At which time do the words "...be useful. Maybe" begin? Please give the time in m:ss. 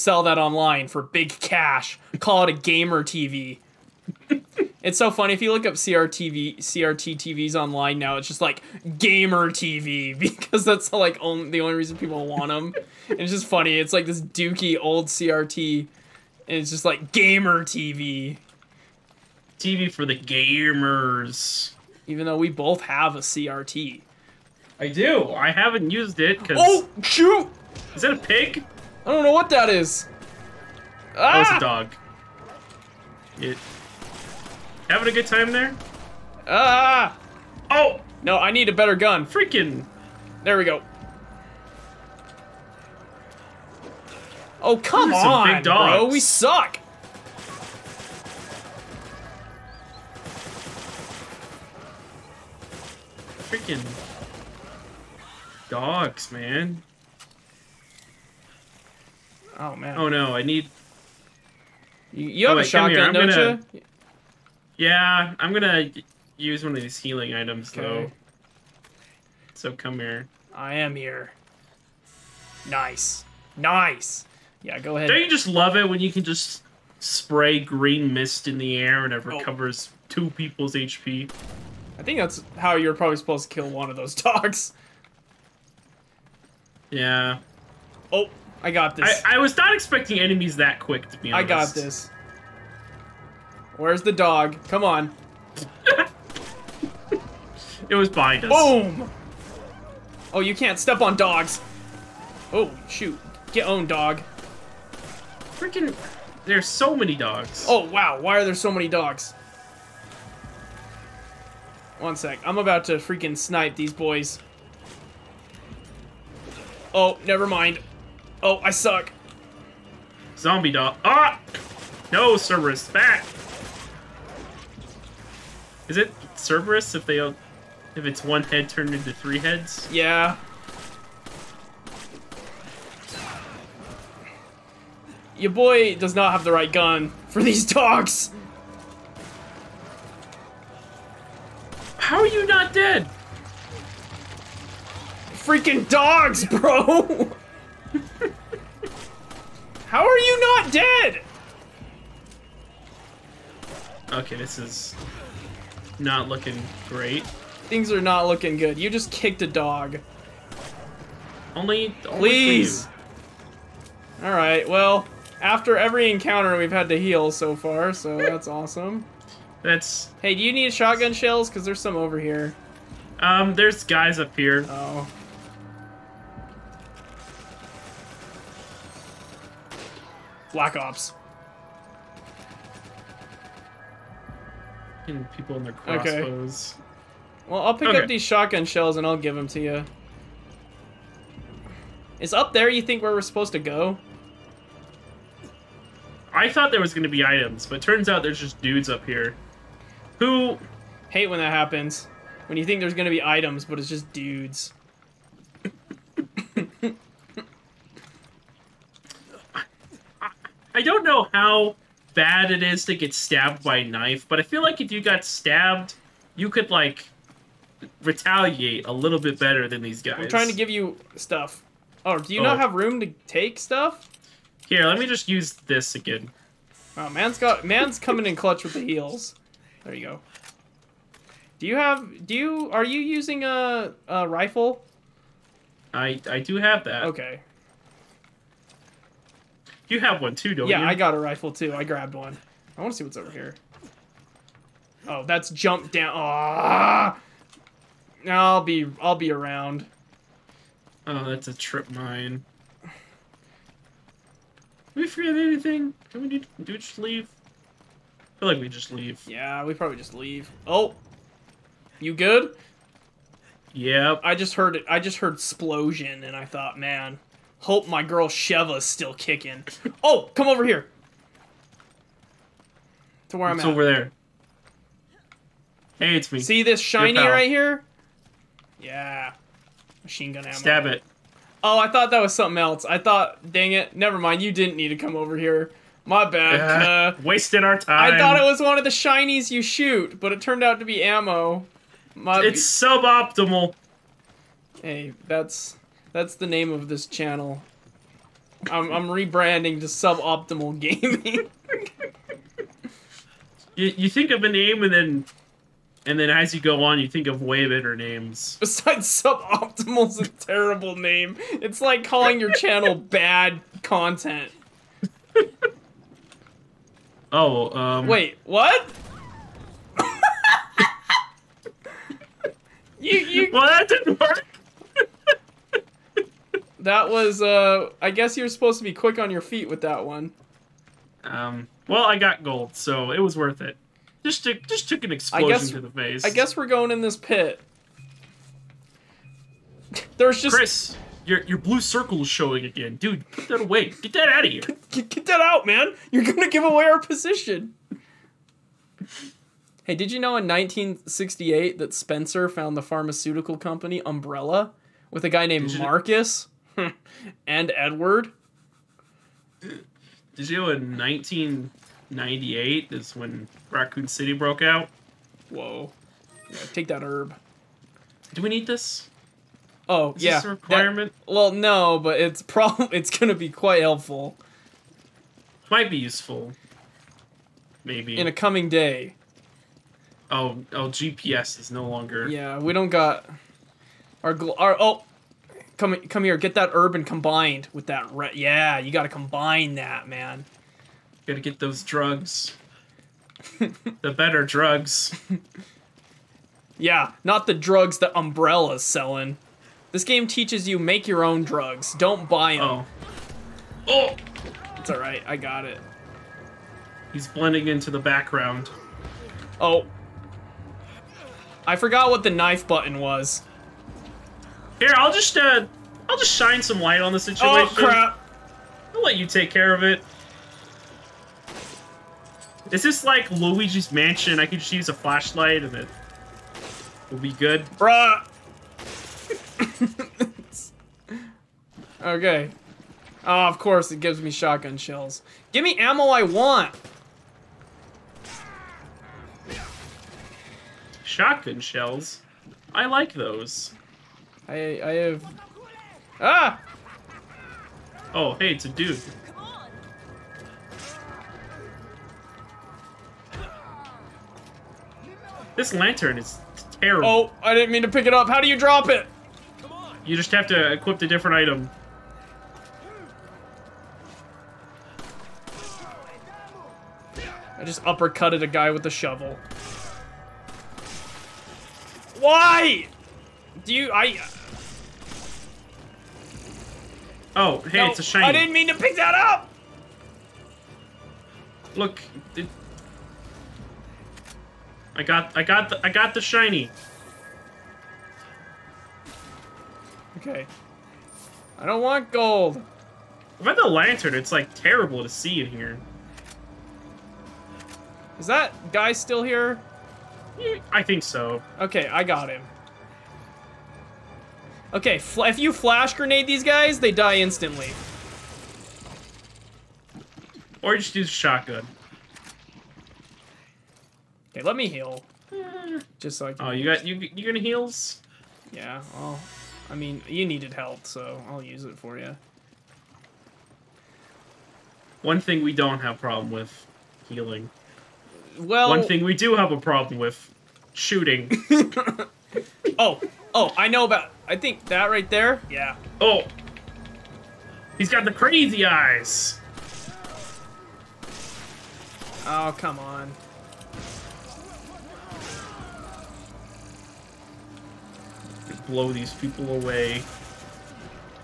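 6:15.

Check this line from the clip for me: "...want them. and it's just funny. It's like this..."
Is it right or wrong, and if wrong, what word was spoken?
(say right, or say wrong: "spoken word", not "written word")
right.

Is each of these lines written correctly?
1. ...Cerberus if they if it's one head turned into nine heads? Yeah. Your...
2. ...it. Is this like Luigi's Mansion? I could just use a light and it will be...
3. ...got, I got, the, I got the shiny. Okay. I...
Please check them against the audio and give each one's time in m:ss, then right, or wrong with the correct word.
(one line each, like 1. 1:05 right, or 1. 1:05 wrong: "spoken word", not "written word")
1. 2:06 wrong: "three", not "nine"
2. 6:59 wrong: "flashlight", not "light"
3. 8:05 right.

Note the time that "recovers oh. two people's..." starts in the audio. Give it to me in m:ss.
1:19.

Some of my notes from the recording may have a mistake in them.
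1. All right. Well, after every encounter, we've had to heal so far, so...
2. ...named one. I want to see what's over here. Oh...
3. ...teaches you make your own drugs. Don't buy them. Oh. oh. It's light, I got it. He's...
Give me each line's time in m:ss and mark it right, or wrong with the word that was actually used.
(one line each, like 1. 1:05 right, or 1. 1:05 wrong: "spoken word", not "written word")
1. 2:44 right
2. 4:01 wrong: "grabbed", not "named"
3. 6:40 wrong: "alright", not "light".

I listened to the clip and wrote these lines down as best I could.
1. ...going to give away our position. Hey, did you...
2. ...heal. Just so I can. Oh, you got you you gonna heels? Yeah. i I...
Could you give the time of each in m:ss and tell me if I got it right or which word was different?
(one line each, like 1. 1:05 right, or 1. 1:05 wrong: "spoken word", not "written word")
1. 5:46 right
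2. 8:34 wrong: "heals", not "heels".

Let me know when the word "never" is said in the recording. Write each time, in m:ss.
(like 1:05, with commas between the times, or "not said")
1:57, 4:43.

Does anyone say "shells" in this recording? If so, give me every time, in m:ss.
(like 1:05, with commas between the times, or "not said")
2:51, 3:08, 7:14, 7:21.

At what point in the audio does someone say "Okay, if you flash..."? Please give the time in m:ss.
8:24.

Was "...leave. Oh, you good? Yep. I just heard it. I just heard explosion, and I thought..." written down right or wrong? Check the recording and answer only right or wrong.
right.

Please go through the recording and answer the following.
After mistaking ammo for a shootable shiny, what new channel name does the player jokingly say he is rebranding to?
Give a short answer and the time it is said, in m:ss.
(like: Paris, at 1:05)
Suboptimal Gaming, at 4:59.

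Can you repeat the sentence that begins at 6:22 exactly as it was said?
Yeah, we don't got our gl- our oh Come come here, get that urban combined with that red.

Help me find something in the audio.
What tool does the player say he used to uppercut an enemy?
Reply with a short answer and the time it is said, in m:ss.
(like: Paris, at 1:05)
A shovel, at 7:48.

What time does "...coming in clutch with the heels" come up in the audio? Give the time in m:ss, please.
3:47.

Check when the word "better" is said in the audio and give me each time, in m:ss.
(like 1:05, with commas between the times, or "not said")
0:38, 3:39, 5:07, 6:34.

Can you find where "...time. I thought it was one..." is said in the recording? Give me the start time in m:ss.
4:47.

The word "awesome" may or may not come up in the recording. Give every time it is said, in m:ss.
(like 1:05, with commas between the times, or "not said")
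2:48.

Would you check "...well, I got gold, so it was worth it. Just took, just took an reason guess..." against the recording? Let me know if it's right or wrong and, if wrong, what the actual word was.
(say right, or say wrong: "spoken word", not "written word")
wrong: "explosion", not "reason".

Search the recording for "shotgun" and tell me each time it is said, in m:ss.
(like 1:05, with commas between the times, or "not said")
1:02, 2:50, 3:08, 7:14, 7:21, 8:31.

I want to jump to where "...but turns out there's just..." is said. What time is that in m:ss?
3:17.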